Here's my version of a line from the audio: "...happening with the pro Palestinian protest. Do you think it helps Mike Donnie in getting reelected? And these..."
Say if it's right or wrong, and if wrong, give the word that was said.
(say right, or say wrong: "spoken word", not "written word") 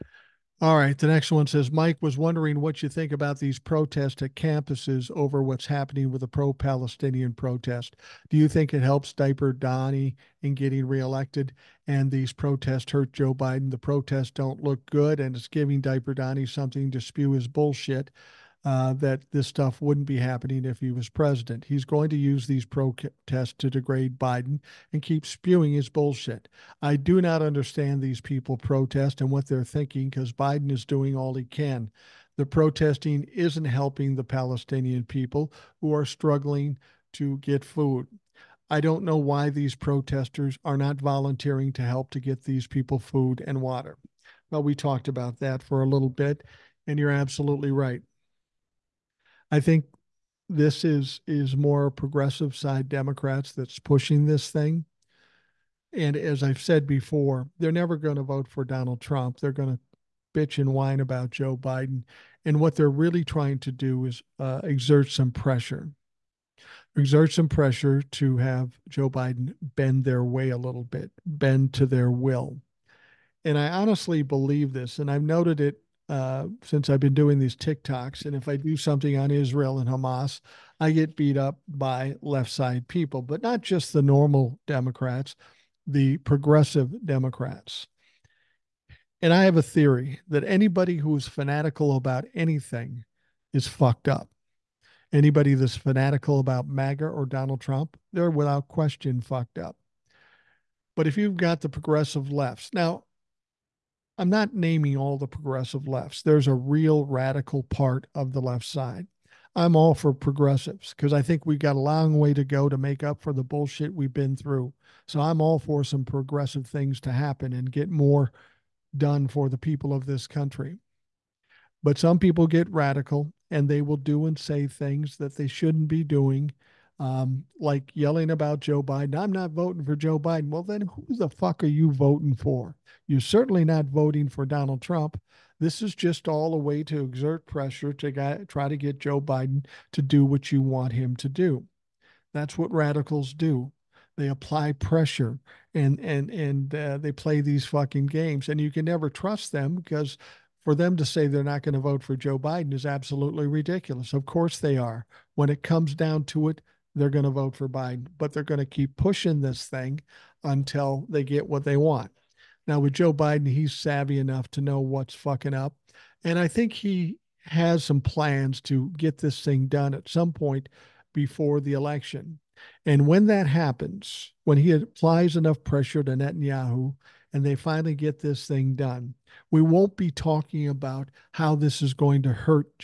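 wrong: "Diaper", not "Mike".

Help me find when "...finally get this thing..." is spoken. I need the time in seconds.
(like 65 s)
177 s.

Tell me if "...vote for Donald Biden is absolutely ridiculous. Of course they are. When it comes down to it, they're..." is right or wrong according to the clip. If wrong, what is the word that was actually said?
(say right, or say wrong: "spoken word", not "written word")
wrong: "Joe", not "Donald".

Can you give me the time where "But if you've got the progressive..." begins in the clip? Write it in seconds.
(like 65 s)
100 s.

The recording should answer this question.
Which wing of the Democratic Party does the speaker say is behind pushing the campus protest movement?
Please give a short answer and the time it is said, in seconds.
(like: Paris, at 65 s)
Progressive side Democrats, at 51 s.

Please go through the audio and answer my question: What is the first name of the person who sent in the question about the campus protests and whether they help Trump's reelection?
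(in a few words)
Mike.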